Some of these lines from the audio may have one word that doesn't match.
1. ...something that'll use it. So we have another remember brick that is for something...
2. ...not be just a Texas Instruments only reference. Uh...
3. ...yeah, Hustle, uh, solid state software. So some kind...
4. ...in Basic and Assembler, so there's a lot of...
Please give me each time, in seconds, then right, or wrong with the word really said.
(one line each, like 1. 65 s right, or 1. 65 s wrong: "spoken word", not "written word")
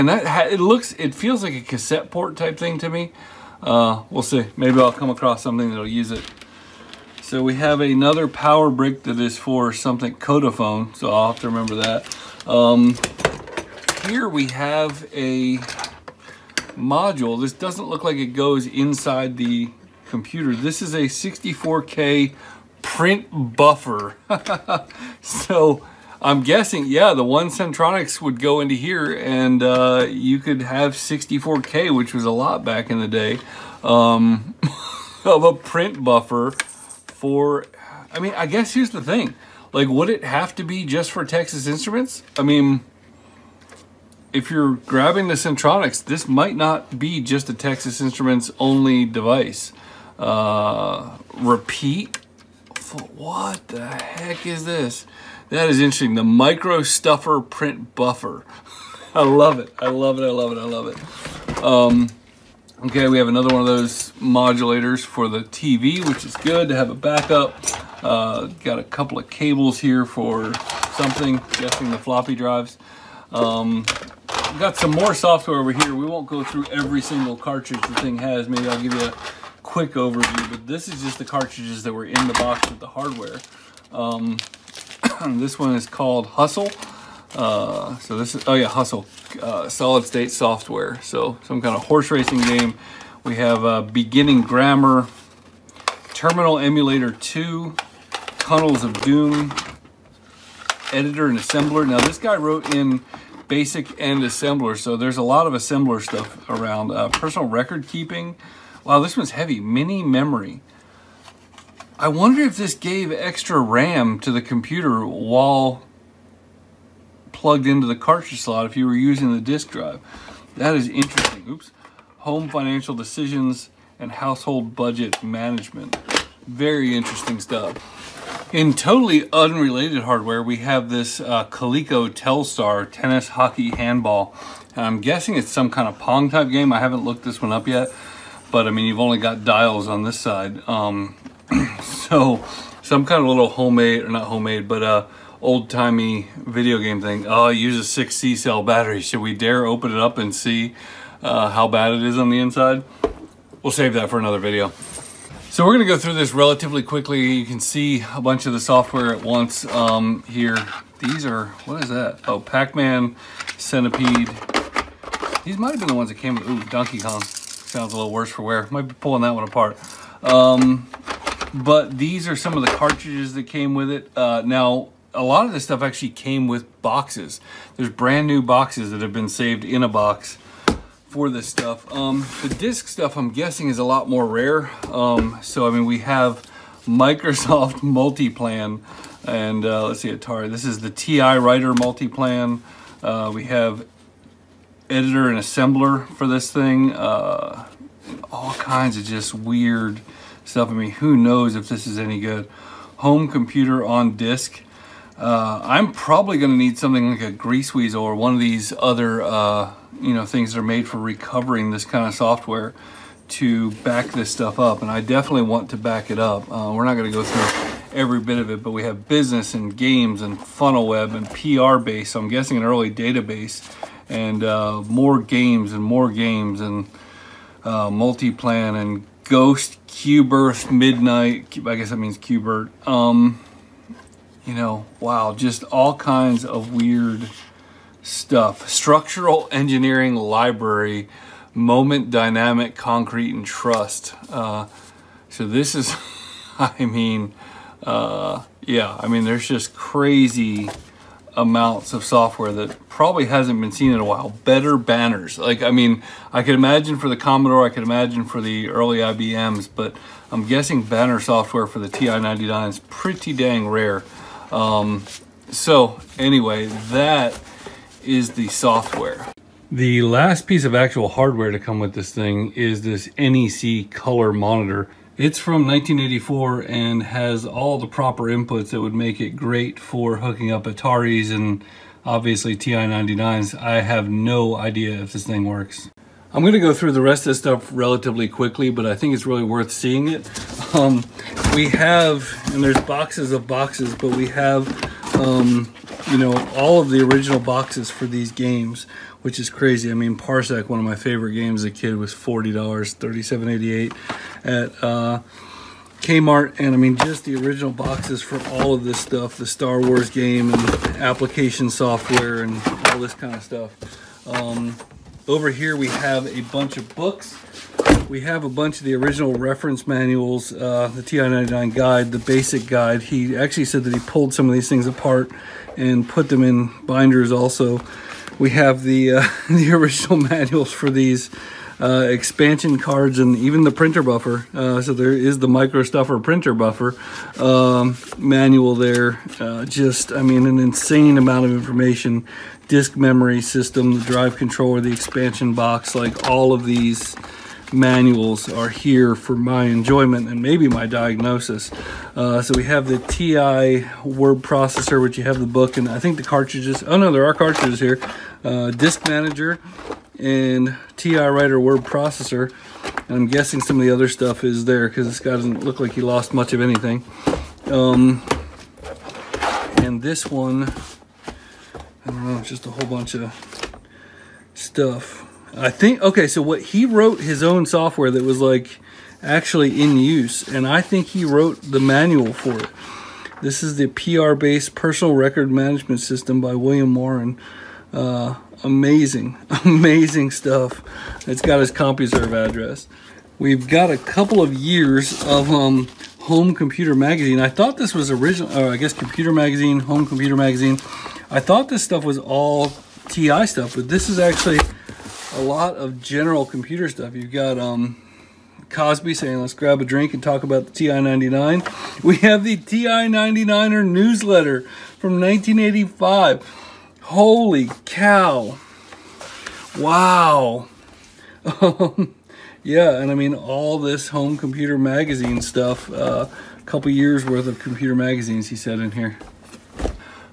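1. 5 s wrong: "power", not "remember"
2. 46 s wrong: "device", not "reference"
3. 88 s right
4. 102 s right.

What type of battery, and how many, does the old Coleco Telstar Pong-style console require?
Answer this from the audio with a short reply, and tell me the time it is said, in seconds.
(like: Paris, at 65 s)
6 C cells, at 148 s.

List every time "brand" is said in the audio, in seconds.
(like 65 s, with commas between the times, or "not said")
177 s.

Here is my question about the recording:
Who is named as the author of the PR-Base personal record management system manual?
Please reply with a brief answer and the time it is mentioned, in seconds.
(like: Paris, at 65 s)
William Warren, at 386 s.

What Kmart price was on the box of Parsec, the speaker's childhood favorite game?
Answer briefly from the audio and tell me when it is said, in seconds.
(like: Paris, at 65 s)
$37.88, at 302 s.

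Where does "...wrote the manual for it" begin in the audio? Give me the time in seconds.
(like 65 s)
381 s.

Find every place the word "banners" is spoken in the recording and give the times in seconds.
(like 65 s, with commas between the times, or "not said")
254 s, 260 s.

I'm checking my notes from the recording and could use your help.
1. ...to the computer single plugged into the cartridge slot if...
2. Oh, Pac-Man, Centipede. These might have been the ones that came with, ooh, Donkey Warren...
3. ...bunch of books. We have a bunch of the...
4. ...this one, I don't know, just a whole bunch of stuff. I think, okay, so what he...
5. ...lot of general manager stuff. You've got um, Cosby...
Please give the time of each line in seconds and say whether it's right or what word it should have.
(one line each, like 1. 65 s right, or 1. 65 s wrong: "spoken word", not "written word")
1. 114 s wrong: "while", not "single"
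2. 162 s wrong: "Kong", not "Warren"
3. 316 s right
4. 370 s right
5. 405 s wrong: "computer", not "manager".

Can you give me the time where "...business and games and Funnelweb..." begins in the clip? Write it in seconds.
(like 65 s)
219 s.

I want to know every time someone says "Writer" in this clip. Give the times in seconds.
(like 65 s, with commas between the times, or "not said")
191 s, 361 s.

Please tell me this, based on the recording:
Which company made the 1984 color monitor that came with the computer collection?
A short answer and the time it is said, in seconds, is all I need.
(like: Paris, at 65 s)
NEC, at 273 s.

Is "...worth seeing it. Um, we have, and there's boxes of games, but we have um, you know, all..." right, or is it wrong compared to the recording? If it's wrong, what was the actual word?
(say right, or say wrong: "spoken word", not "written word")
wrong: "boxes", not "games".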